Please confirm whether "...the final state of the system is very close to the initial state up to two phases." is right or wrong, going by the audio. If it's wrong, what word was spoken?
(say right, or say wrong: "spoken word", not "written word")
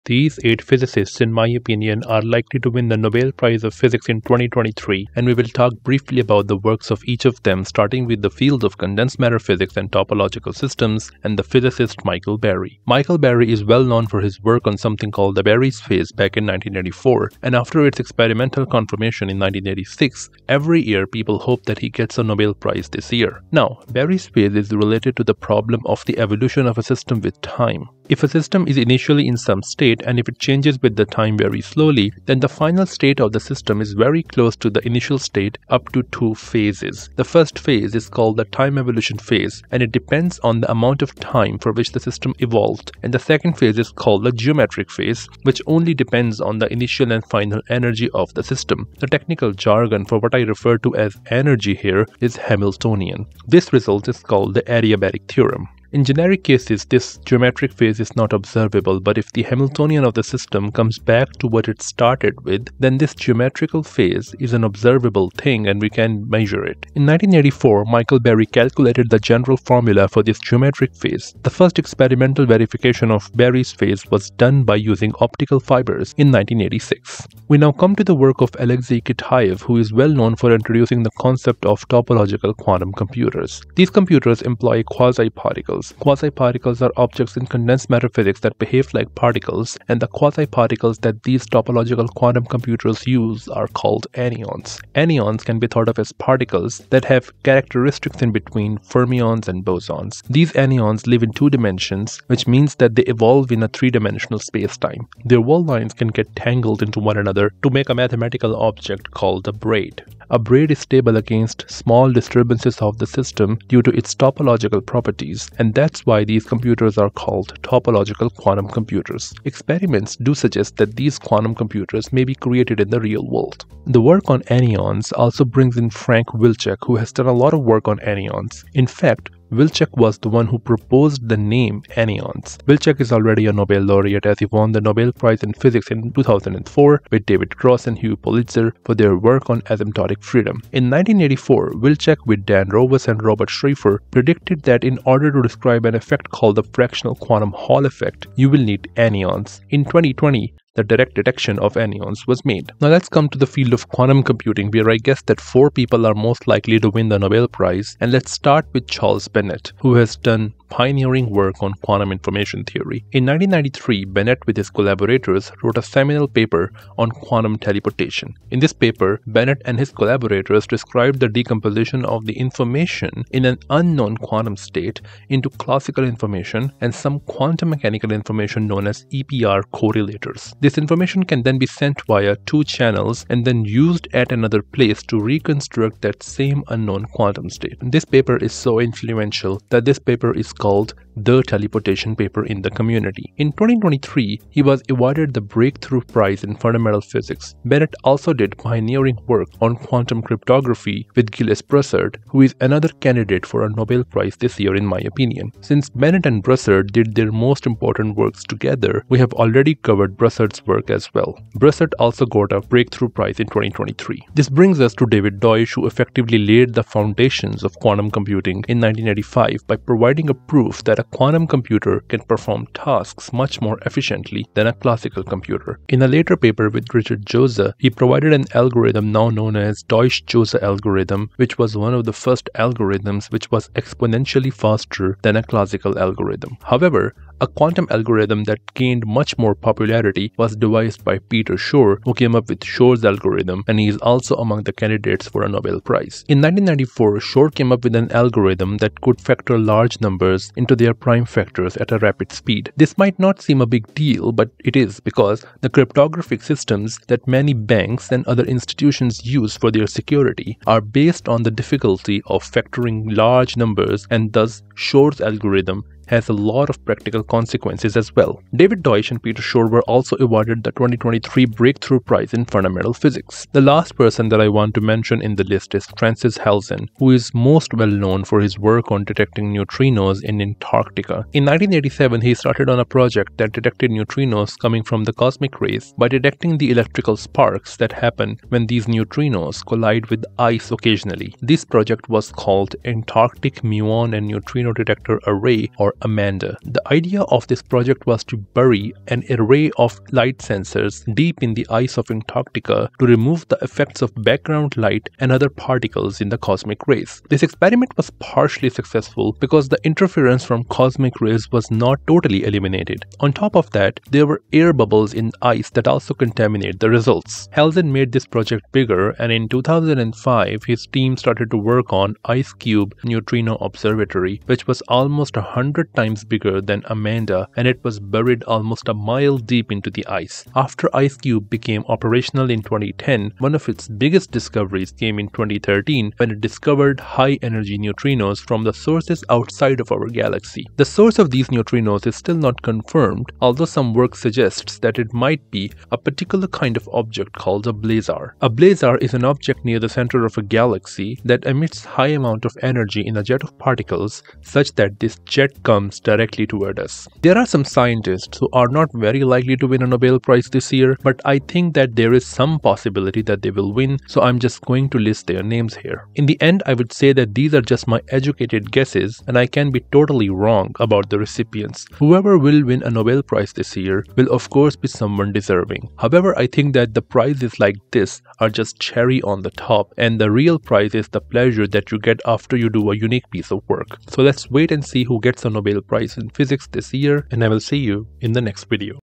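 right.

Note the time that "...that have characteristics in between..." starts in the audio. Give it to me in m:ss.
1:36.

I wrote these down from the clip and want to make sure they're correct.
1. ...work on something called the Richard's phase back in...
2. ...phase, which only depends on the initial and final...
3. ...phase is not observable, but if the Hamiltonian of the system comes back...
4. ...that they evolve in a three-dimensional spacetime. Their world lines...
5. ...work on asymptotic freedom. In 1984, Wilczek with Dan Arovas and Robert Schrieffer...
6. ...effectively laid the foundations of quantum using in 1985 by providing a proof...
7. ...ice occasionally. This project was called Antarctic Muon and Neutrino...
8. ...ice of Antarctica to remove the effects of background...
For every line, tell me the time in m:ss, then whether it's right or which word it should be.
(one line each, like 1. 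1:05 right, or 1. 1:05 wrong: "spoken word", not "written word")
1. 0:14 wrong: "Berry", not "Richard"
2. 0:44 right
3. 0:57 right
4. 1:42 right
5. 2:19 right
6. 3:35 wrong: "computing", not "using"
7. 4:50 right
8. 5:01 right.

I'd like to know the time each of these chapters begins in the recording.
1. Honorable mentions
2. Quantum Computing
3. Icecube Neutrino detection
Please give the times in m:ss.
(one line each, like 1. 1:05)
1. 5:57
2. 2:32
3. 4:33.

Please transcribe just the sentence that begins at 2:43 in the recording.
In 1993, Bennett with his collaborators wrote a seminal paper on quantum teleportation.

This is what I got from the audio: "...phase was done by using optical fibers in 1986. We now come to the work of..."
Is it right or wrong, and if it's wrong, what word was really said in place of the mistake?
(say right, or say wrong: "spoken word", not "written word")
right.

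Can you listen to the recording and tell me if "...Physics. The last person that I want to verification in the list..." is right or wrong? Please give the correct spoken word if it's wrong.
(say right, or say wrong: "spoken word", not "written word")
wrong: "mention", not "verification".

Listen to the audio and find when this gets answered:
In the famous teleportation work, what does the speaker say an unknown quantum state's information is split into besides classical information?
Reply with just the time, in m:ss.
2:59.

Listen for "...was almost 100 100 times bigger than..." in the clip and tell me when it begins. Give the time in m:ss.
5:24.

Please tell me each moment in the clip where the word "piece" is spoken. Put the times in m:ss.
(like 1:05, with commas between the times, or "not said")
6:23.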